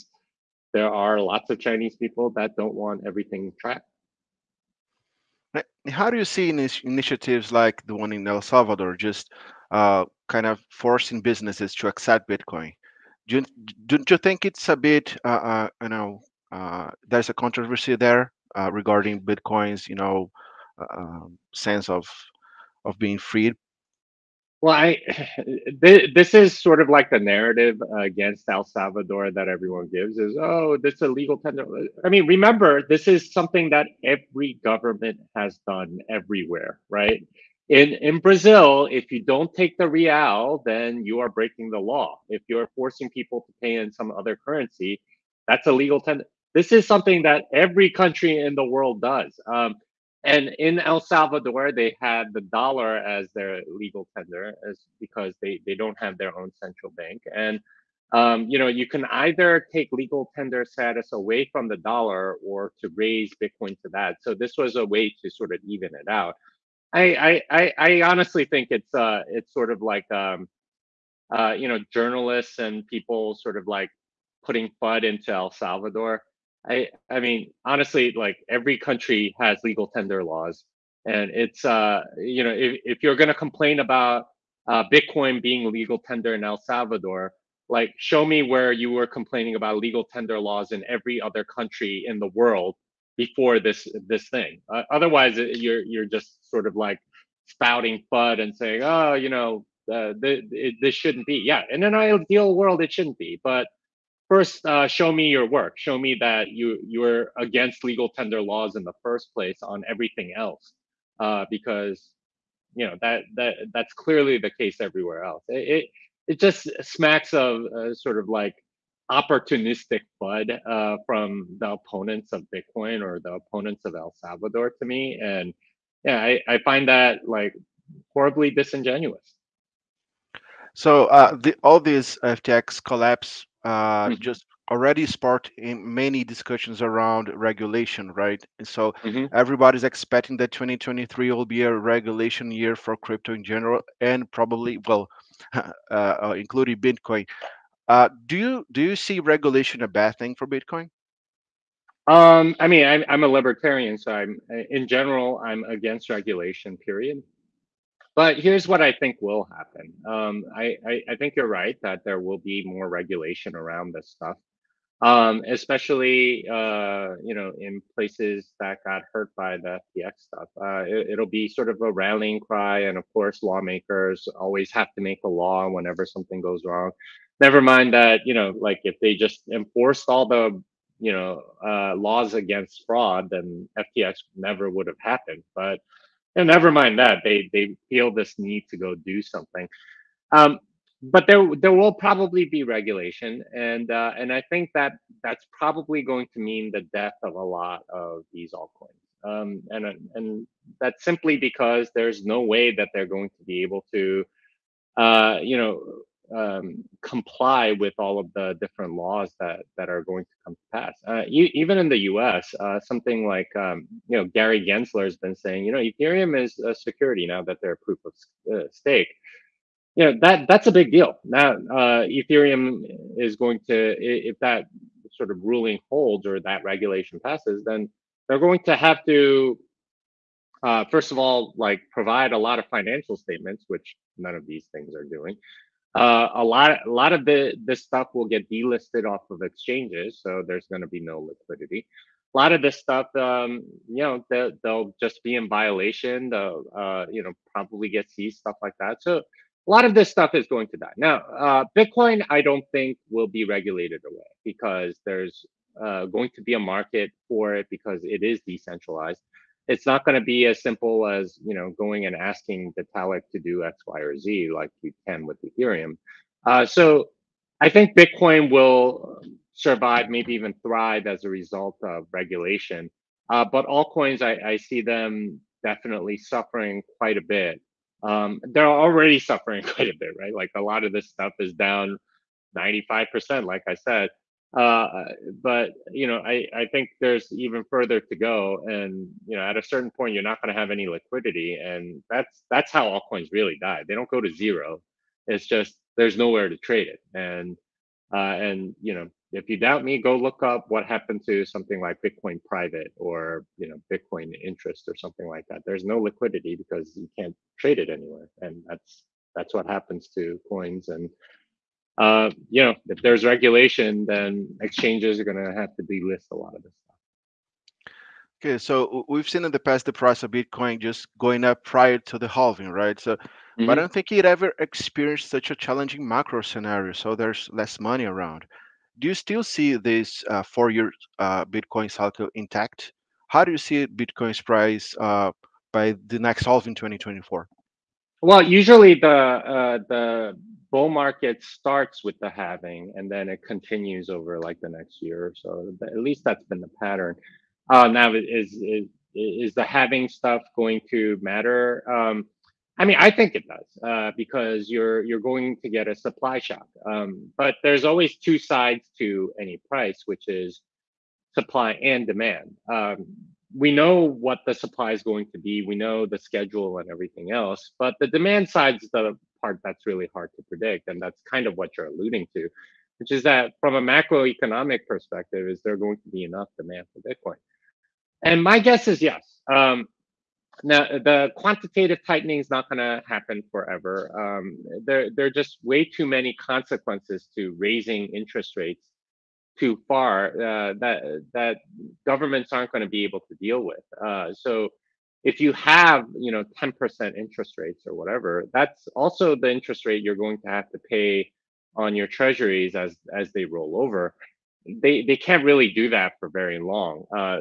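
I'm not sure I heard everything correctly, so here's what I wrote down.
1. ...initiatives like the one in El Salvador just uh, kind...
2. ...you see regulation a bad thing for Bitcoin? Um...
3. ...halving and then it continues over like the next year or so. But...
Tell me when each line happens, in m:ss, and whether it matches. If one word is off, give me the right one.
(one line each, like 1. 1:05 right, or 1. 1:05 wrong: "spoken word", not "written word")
1. 0:06 right
2. 2:28 right
3. 5:42 right.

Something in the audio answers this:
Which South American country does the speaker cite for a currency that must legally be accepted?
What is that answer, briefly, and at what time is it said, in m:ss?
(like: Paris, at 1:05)
Brazil, at 0:38.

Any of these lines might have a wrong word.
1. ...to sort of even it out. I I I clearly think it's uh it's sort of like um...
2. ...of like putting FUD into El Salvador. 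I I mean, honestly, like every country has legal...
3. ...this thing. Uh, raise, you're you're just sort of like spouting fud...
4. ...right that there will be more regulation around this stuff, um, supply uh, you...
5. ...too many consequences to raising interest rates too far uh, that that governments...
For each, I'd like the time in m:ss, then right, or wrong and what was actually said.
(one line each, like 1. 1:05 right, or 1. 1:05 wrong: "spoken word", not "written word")
1. 1:05 wrong: "honestly", not "clearly"
2. 1:13 right
3. 1:34 wrong: "otherwise", not "raise"
4. 2:41 wrong: "especially", not "supply"
5. 6:25 right.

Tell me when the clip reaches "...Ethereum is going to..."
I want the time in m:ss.
3:42.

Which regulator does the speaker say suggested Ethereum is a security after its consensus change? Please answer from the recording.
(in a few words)
Gary Gensler.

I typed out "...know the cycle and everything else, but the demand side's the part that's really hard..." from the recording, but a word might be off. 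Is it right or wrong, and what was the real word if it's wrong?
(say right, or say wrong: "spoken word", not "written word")
wrong: "schedule", not "cycle".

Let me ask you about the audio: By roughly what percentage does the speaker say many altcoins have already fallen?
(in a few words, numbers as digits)
95%.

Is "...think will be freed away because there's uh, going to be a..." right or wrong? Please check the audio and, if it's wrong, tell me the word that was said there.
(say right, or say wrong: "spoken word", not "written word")
wrong: "regulated", not "freed".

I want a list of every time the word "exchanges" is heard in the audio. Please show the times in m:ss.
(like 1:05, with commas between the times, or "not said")
3:59, 5:14.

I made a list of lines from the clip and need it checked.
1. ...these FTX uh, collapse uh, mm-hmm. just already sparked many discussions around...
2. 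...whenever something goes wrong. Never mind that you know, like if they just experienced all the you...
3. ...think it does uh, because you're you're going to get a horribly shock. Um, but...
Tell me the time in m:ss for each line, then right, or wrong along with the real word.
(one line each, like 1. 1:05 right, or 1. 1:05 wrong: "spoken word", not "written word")
1. 2:11 right
2. 2:55 wrong: "enforced", not "experienced"
3. 5:53 wrong: "supply", not "horribly".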